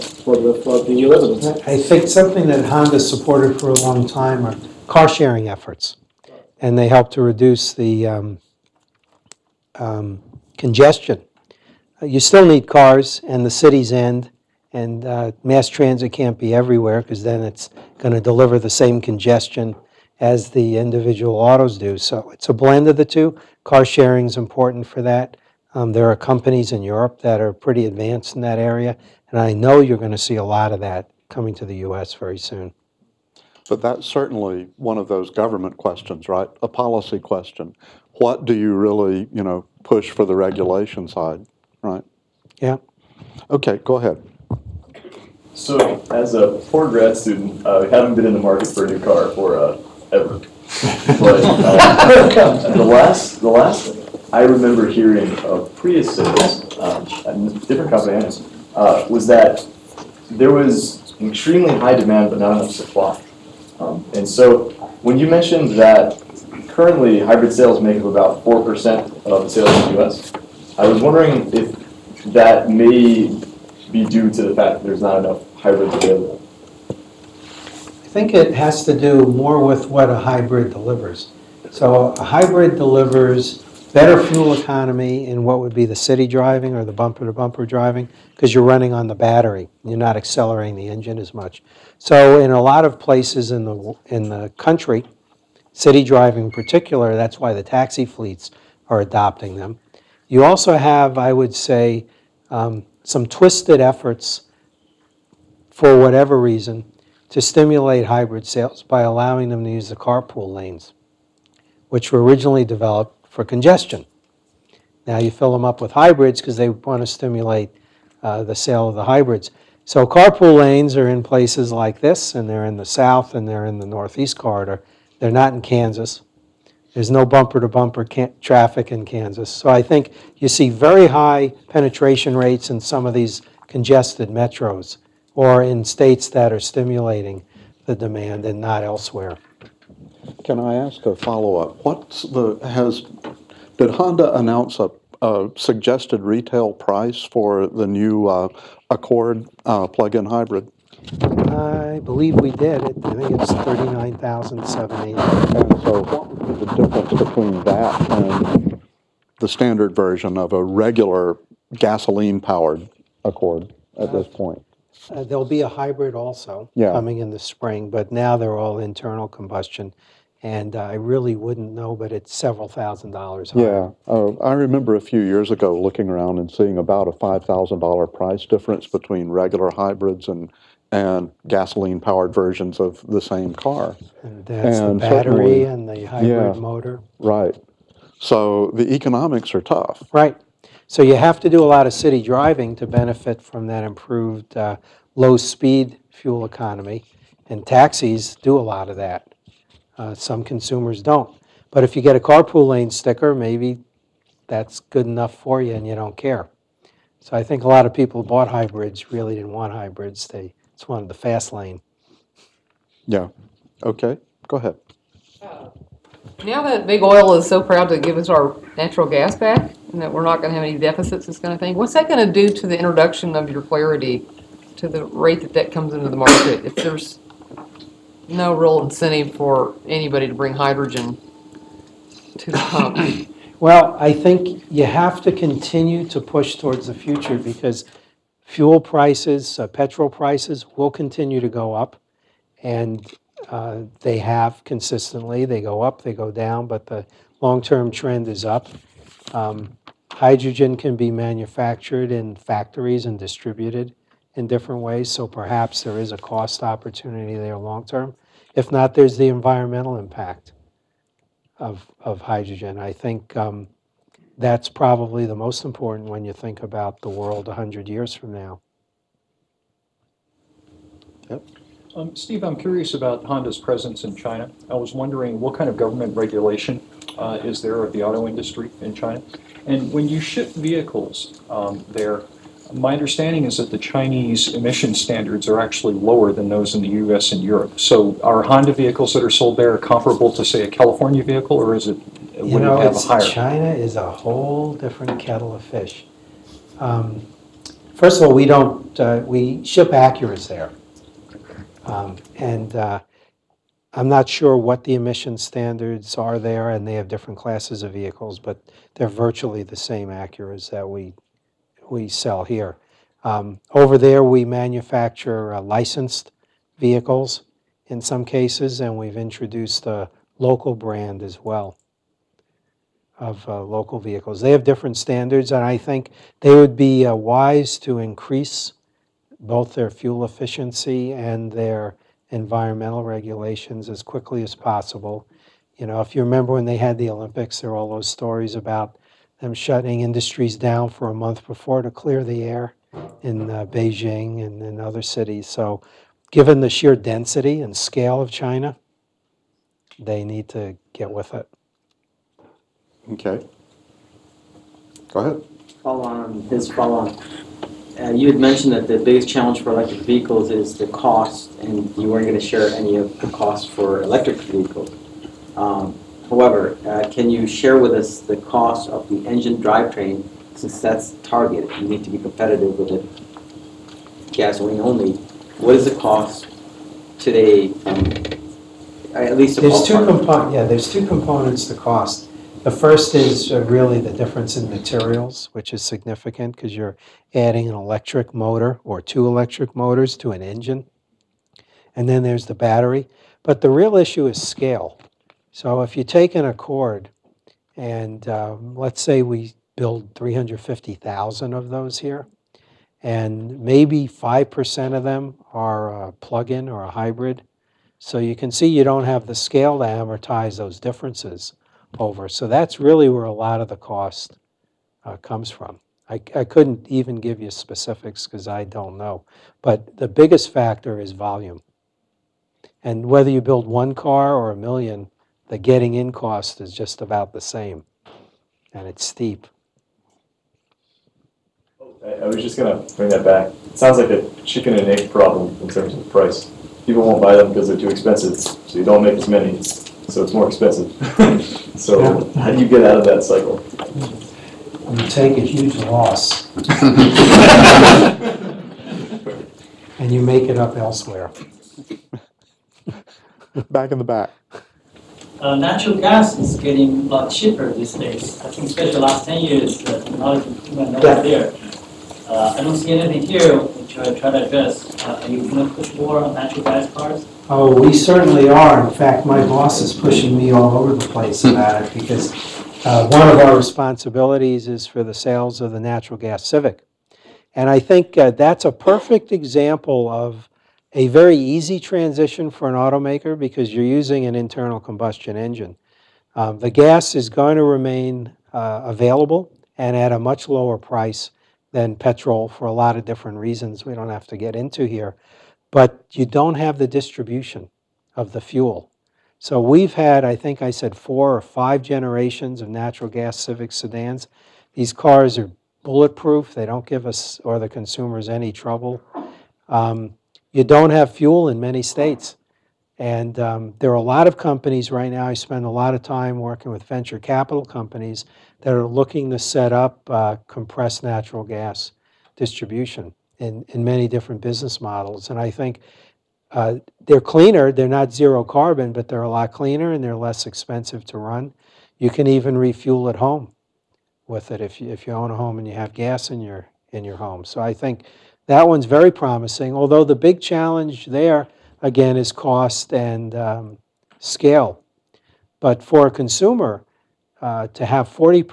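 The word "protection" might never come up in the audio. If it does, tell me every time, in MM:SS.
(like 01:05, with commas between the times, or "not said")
not said.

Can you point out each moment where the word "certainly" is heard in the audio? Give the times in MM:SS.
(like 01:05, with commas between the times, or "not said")
00:34, 07:47.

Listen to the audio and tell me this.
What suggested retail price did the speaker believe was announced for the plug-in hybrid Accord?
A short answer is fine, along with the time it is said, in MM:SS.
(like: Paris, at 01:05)
$39,780, at 02:33.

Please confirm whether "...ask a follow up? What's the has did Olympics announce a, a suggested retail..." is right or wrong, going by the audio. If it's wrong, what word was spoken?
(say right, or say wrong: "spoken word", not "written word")
wrong: "Honda", not "Olympics".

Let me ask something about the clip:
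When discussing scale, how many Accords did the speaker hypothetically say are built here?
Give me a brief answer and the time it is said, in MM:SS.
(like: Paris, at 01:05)
350,000, at 06:40.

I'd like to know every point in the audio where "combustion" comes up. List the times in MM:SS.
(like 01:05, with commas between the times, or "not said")
02:49, 08:04.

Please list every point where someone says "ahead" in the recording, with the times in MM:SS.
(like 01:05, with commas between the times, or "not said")
00:43, 03:34, 05:55.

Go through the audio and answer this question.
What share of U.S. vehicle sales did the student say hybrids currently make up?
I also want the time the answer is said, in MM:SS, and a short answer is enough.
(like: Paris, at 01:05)
4%, at 01:08.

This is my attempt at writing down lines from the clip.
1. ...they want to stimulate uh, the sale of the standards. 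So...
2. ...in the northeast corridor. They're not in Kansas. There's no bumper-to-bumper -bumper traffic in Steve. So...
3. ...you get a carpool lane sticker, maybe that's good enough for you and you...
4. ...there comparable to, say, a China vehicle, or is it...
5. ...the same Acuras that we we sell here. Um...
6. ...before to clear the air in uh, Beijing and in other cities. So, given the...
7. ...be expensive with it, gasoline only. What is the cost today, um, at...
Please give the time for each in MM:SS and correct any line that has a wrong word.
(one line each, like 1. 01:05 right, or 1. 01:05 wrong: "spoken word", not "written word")
1. 01:56 wrong: "hybrids", not "standards"
2. 02:03 wrong: "Kansas", not "Steve"
3. 03:21 right
4. 04:49 wrong: "California", not "China"
5. 05:09 right
6. 05:41 right
7. 06:12 wrong: "competitive", not "expensive".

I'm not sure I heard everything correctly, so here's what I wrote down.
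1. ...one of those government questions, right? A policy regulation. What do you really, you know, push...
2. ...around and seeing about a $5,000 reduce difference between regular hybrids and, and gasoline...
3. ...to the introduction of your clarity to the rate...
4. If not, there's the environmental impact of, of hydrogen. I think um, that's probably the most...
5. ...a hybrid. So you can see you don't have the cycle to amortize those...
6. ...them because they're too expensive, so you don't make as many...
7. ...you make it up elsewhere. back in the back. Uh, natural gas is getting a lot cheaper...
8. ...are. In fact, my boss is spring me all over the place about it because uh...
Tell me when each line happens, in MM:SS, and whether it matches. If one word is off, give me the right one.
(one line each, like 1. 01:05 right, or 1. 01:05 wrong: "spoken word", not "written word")
1. 00:34 wrong: "question", not "regulation"
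2. 02:56 wrong: "price", not "reduce"
3. 03:42 right
4. 04:18 right
5. 06:46 wrong: "scale", not "cycle"
6. 07:17 right
7. 07:30 right
8. 07:48 wrong: "pushing", not "spring".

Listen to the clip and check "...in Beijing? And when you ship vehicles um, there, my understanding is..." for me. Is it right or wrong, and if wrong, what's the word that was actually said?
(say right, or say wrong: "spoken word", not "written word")
wrong: "China", not "Beijing".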